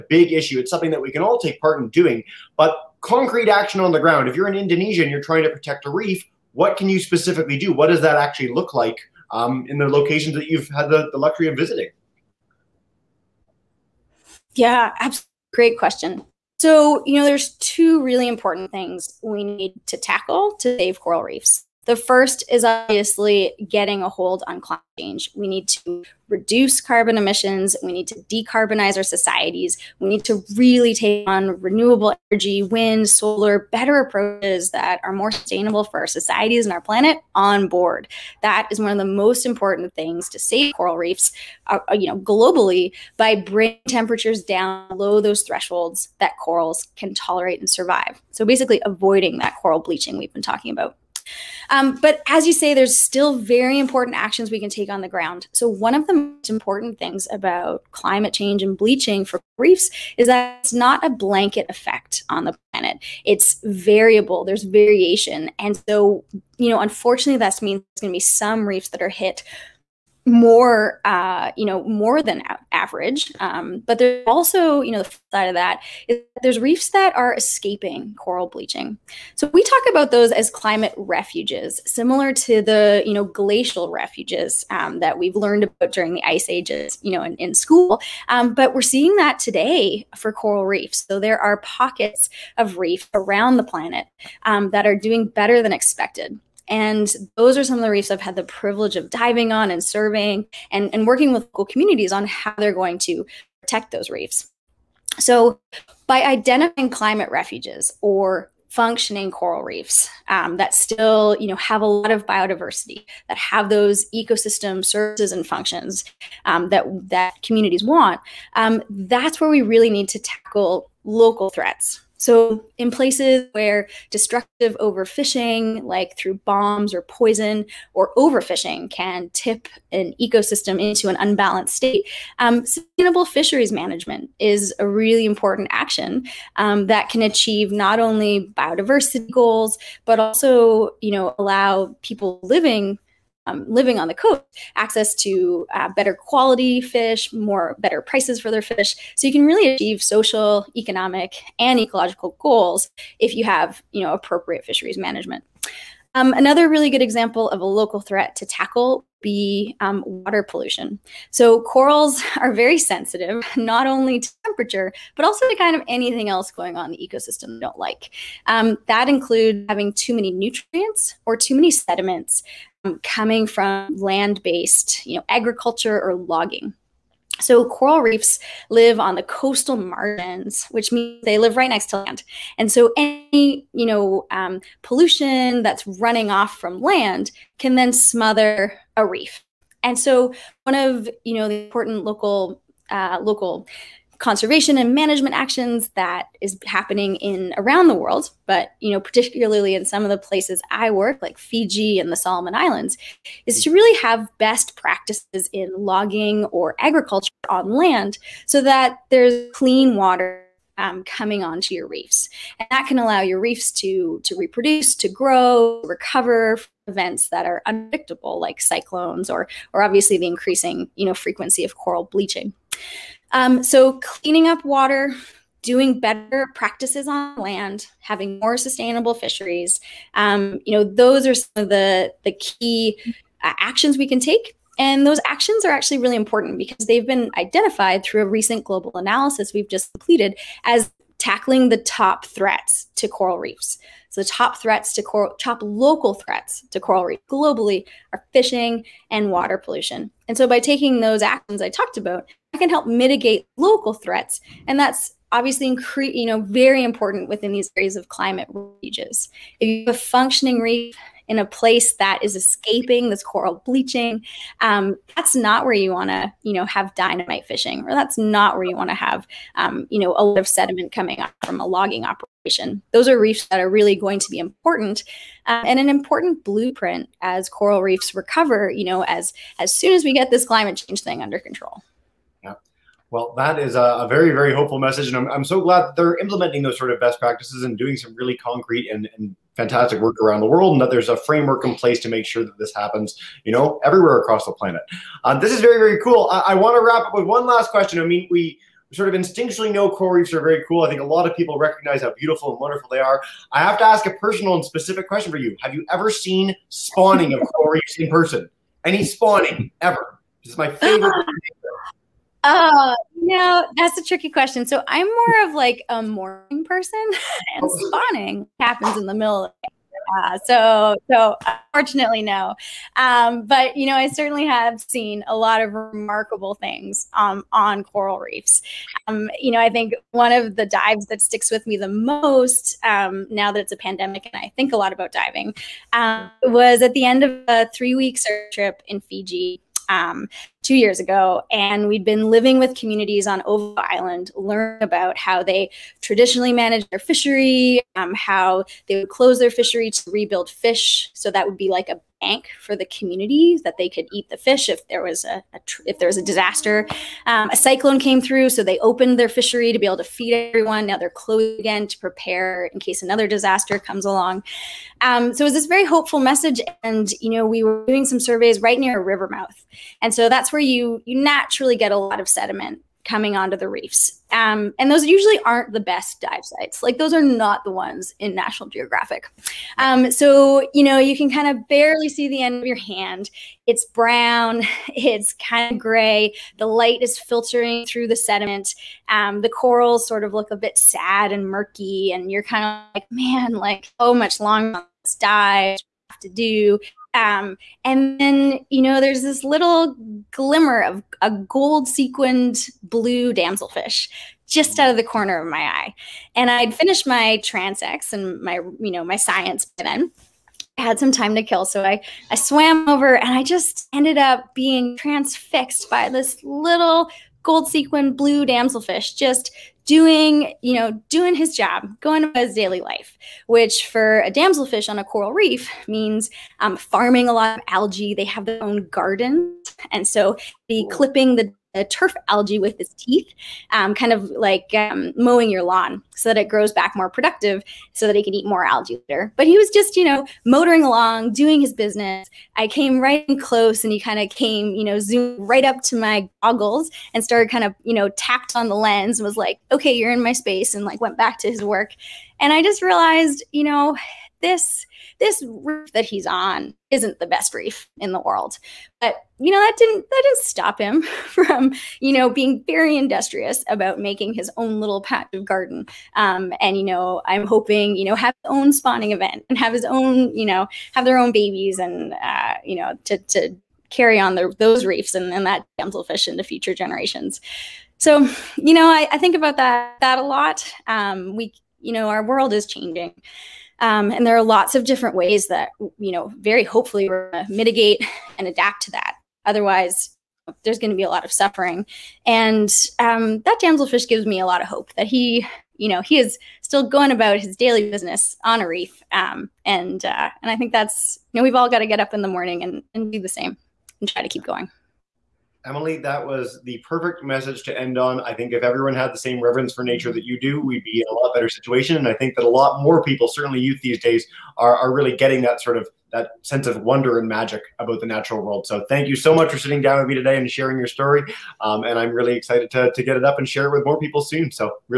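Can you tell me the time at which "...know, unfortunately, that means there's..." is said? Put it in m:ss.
1:06.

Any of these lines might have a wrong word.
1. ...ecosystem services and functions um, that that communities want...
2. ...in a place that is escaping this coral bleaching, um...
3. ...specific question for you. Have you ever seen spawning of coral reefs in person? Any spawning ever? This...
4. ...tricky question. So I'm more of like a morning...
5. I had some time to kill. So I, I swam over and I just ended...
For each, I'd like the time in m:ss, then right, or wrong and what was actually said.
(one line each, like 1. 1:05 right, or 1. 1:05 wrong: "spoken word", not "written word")
1. 1:54 right
2. 4:21 right
3. 5:04 right
4. 5:14 right
5. 6:50 right.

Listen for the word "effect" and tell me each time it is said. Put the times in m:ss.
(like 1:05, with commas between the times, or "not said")
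1:01.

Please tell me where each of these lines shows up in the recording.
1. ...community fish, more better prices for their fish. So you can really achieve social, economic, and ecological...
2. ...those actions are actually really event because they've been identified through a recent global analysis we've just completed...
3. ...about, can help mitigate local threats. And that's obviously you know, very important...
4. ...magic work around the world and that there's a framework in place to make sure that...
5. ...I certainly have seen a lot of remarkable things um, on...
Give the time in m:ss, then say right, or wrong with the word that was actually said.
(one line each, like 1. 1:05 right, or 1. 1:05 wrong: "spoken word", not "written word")
1. 2:26 wrong: "quality", not "community"
2. 3:55 wrong: "important", not "event"
3. 4:11 right
4. 4:49 wrong: "fantastic", not "magic"
5. 5:23 right.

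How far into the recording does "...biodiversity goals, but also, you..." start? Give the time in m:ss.
2:18.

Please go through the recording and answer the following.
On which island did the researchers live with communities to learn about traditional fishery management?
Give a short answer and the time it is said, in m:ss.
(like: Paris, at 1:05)
Ova Island, at 5:43.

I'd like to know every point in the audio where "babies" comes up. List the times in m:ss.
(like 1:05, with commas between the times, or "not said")
7:51.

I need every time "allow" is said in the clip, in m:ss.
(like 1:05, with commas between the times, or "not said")
2:21, 3:32.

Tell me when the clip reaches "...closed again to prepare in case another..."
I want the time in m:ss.
6:01.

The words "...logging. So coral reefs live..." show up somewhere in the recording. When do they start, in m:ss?
2:56.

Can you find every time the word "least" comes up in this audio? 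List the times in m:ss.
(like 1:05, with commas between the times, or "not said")
not said.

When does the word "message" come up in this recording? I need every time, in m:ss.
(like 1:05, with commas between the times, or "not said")
4:44, 6:06, 8:27.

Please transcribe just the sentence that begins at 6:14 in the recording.
Um, and those usually aren't the best dive sites.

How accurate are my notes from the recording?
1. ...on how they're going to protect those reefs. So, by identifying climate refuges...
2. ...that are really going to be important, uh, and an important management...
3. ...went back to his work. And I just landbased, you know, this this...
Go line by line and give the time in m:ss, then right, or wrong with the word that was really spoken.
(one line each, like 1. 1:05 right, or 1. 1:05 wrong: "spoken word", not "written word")
1. 1:42 right
2. 4:33 wrong: "blueprint", not "management"
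3. 7:30 wrong: "realized", not "landbased".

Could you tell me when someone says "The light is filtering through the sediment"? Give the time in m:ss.
6:26.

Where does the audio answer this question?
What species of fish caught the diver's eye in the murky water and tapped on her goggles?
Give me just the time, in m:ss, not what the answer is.
6:41.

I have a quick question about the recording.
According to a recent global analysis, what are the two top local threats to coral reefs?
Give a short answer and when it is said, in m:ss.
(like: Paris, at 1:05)
fishing and water pollution, at 4:08.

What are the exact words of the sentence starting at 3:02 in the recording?
And so any, you know, um, pollution that's running off from land can then smother a reef.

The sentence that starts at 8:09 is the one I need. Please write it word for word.
Otherwise, there's going to be a lot of suffering.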